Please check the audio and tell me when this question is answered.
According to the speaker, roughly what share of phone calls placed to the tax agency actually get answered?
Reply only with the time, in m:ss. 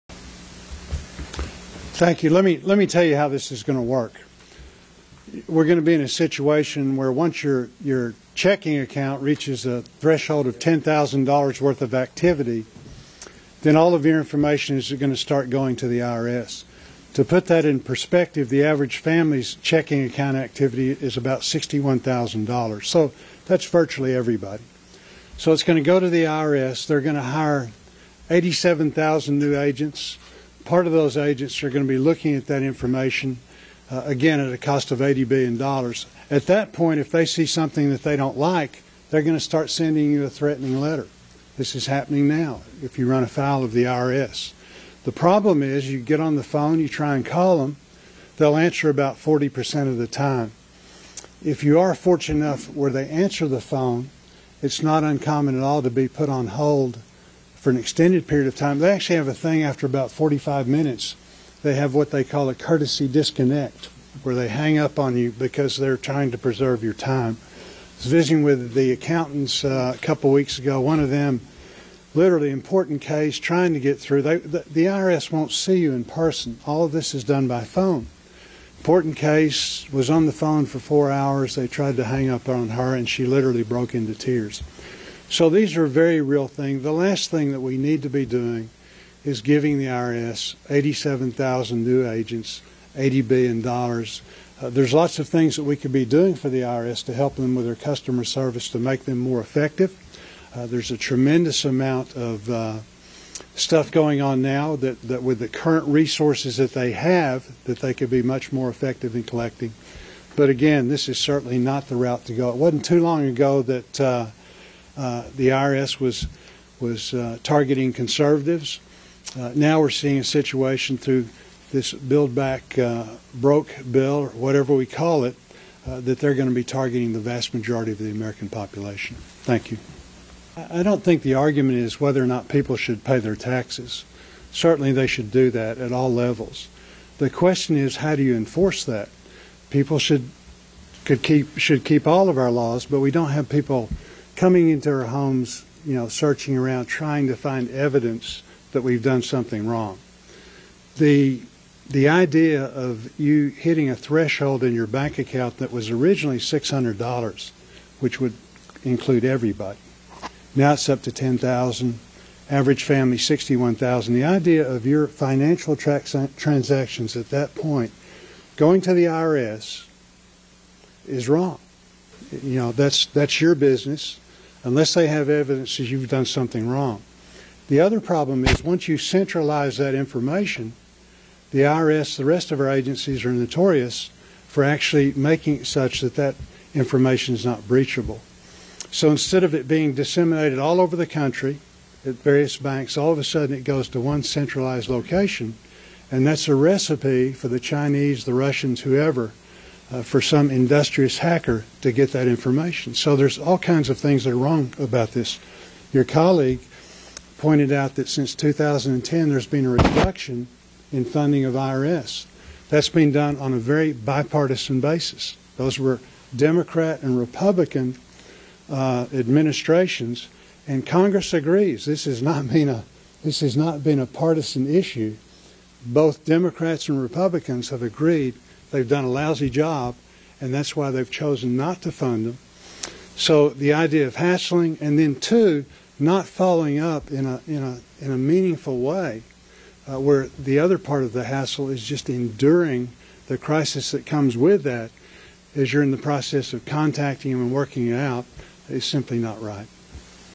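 0:49.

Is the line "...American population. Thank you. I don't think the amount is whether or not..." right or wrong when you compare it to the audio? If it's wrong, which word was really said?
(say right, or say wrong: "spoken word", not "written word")
wrong: "argument", not "amount".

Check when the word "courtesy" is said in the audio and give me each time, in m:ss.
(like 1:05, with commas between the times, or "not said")
1:02.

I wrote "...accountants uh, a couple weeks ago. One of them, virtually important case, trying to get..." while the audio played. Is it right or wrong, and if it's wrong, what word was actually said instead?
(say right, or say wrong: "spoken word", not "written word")
wrong: "literally", not "virtually".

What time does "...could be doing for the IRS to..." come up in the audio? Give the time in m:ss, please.
1:35.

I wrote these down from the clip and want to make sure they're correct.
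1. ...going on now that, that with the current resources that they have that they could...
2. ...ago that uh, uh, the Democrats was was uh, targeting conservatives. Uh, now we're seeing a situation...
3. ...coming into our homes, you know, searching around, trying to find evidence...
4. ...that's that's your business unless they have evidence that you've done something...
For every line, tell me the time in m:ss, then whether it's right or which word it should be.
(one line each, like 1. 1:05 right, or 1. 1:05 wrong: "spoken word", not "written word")
1. 1:43 right
2. 1:53 wrong: "IRS", not "Democrats"
3. 2:24 right
4. 2:52 right.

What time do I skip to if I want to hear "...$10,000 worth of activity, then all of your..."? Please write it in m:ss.
0:10.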